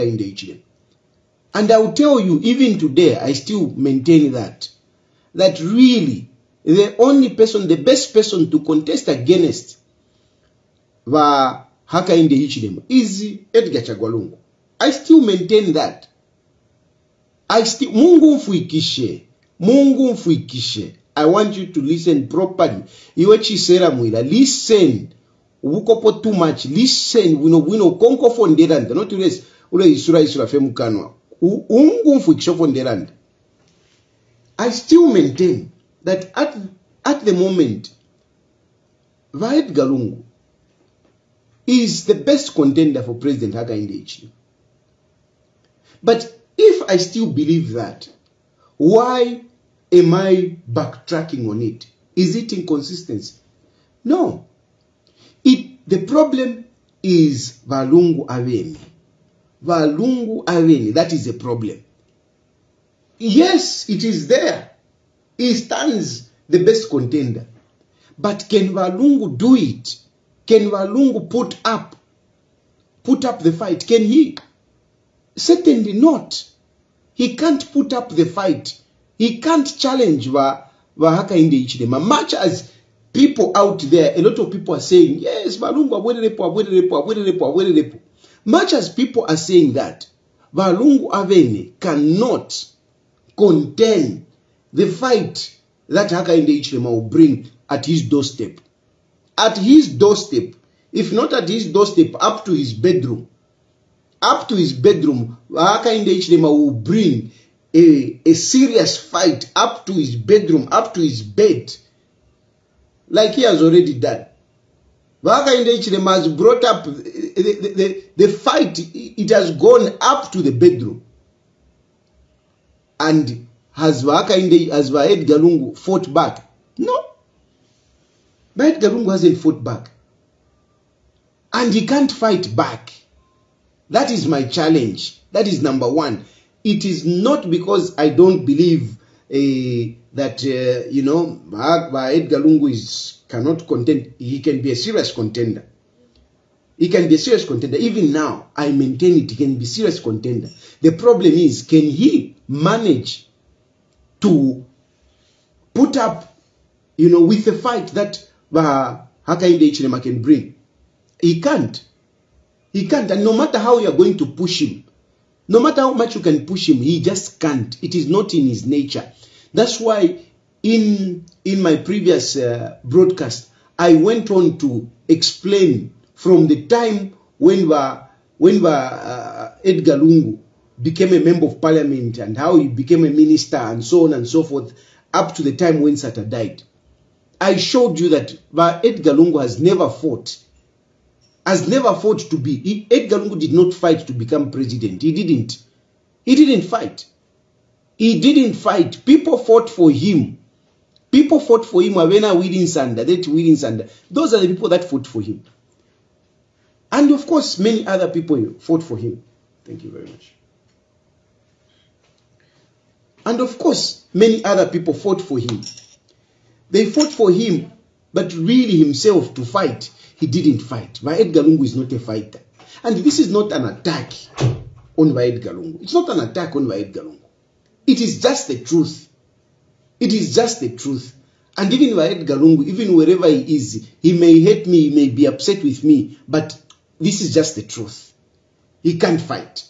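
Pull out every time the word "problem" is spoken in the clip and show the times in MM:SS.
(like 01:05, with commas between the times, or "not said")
00:56, 01:01, 02:30.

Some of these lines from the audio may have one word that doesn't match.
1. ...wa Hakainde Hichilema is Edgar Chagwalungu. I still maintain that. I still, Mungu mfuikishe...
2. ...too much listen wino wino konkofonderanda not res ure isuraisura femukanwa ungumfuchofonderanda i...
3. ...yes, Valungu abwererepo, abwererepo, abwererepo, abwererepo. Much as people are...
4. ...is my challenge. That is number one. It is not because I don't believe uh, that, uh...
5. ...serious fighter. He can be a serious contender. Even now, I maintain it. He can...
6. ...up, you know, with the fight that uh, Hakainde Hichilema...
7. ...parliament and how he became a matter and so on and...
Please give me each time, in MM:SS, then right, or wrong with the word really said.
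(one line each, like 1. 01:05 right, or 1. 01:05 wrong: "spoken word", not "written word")
1. 00:11 right
2. 00:26 right
3. 01:25 right
4. 02:14 right
5. 02:24 wrong: "contender", not "fighter"
6. 02:35 right
7. 03:01 wrong: "minister", not "matter".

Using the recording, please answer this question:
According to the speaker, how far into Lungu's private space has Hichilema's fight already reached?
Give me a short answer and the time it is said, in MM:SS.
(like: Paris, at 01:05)
the bedroom, at 02:00.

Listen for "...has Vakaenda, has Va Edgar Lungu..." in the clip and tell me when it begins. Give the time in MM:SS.
02:03.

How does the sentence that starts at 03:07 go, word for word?
I showed you that Edgar Lungu has never fought has never fought to be.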